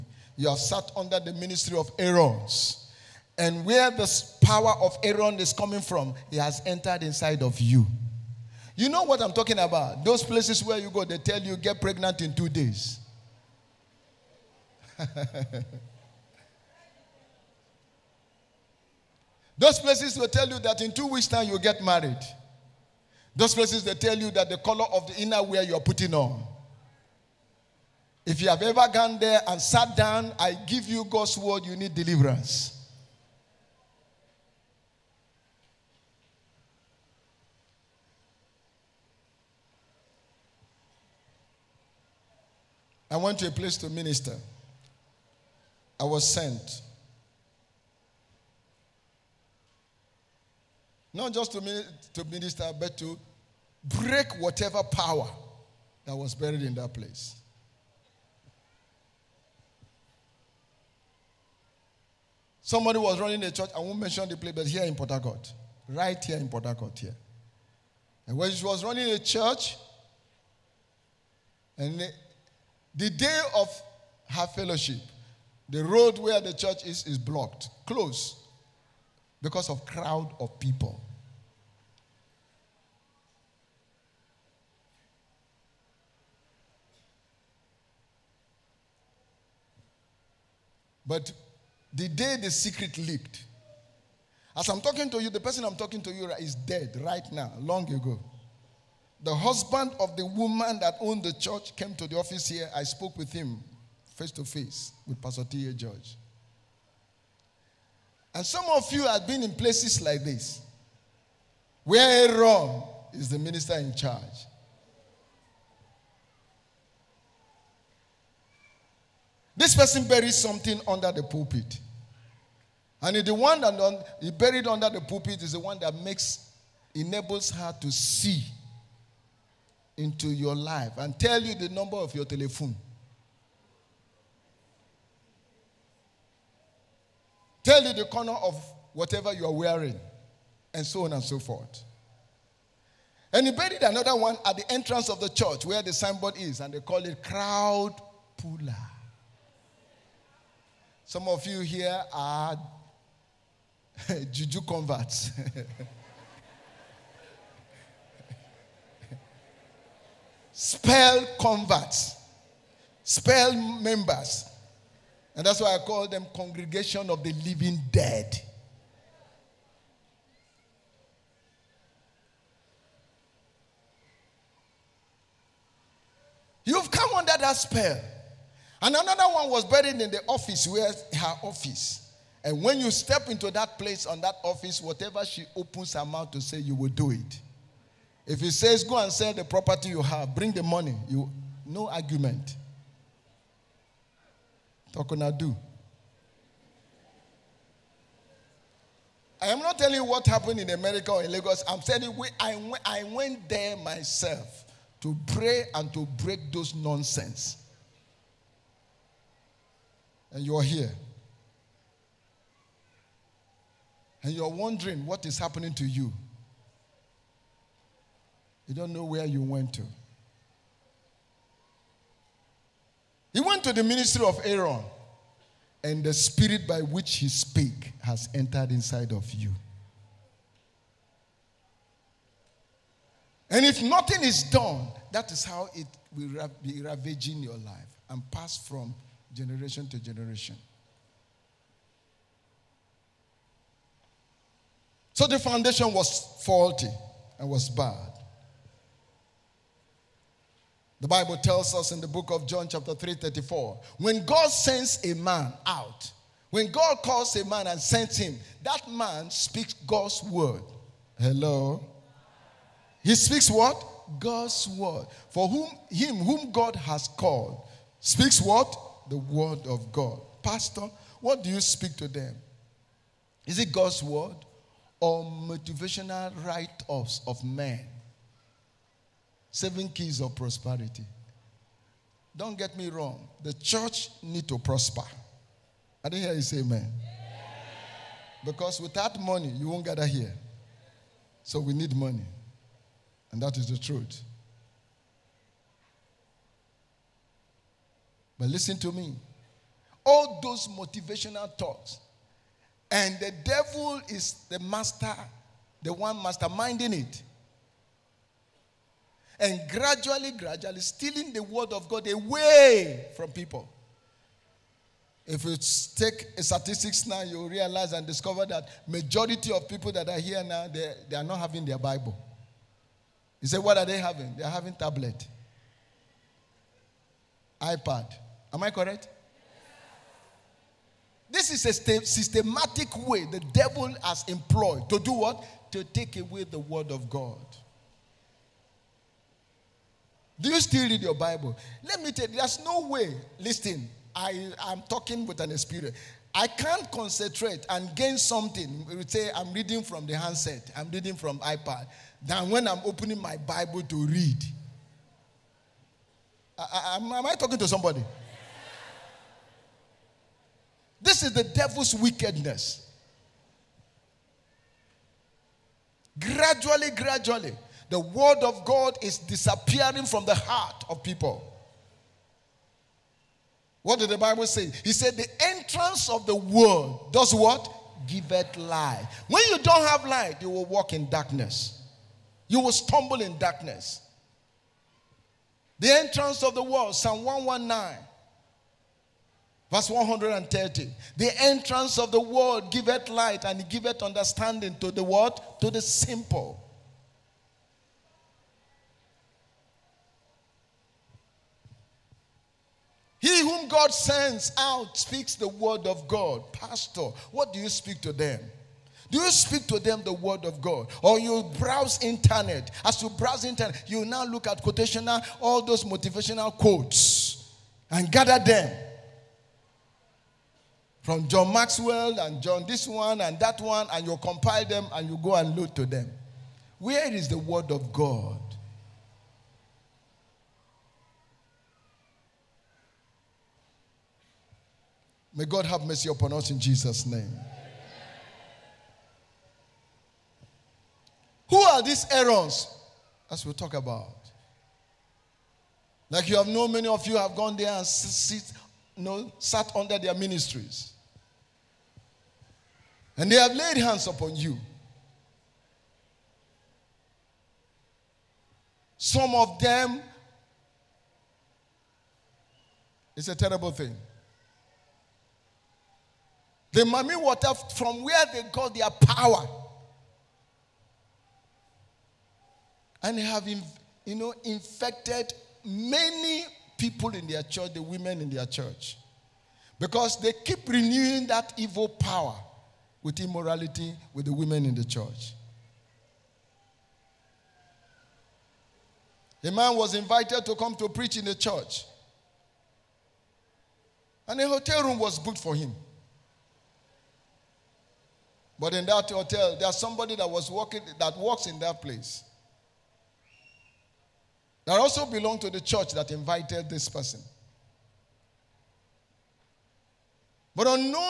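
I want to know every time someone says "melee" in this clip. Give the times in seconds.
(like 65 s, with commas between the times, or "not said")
not said.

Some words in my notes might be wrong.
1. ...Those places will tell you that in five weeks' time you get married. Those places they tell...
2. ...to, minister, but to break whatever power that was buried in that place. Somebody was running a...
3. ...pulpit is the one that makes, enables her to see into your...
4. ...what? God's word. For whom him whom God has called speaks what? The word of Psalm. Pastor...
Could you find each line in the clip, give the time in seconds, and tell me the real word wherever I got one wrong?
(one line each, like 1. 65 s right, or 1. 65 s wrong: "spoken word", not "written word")
1. 19 s wrong: "two", not "five"
2. 51 s right
3. 125 s right
4. 263 s wrong: "God", not "Psalm".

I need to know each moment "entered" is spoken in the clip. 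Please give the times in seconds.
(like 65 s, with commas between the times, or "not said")
6 s, 228 s.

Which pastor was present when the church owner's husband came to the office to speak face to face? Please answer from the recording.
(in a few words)
Pastor T.A. George.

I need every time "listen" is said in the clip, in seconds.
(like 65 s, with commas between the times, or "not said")
298 s, 343 s.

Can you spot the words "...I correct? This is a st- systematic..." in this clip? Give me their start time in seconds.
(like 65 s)
328 s.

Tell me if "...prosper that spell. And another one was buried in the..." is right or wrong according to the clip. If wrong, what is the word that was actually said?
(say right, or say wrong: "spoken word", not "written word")
wrong: "under", not "prosper".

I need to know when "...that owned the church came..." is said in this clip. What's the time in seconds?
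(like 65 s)
100 s.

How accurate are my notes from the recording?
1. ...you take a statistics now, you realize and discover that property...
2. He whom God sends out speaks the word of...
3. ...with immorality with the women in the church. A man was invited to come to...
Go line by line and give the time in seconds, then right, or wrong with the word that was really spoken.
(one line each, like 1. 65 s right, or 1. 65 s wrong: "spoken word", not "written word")
1. 315 s wrong: "majority", not "property"
2. 403 s right
3. 483 s right.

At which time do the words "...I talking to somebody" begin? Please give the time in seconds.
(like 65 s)
357 s.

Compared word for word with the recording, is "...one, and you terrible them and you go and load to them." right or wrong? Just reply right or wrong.
wrong.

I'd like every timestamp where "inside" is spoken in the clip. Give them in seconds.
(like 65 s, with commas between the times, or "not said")
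7 s, 228 s.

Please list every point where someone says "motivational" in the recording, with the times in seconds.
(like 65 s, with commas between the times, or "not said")
275 s, 300 s, 415 s.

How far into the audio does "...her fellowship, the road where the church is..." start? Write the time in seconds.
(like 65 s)
74 s.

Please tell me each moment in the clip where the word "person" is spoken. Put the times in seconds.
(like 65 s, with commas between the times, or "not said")
95 s, 119 s, 506 s.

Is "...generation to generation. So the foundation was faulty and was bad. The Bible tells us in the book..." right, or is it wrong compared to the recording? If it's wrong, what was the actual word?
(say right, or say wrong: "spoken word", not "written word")
right.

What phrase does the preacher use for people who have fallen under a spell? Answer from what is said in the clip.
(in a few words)
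Congregation of the living dead.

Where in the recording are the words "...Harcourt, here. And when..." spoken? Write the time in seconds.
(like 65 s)
66 s.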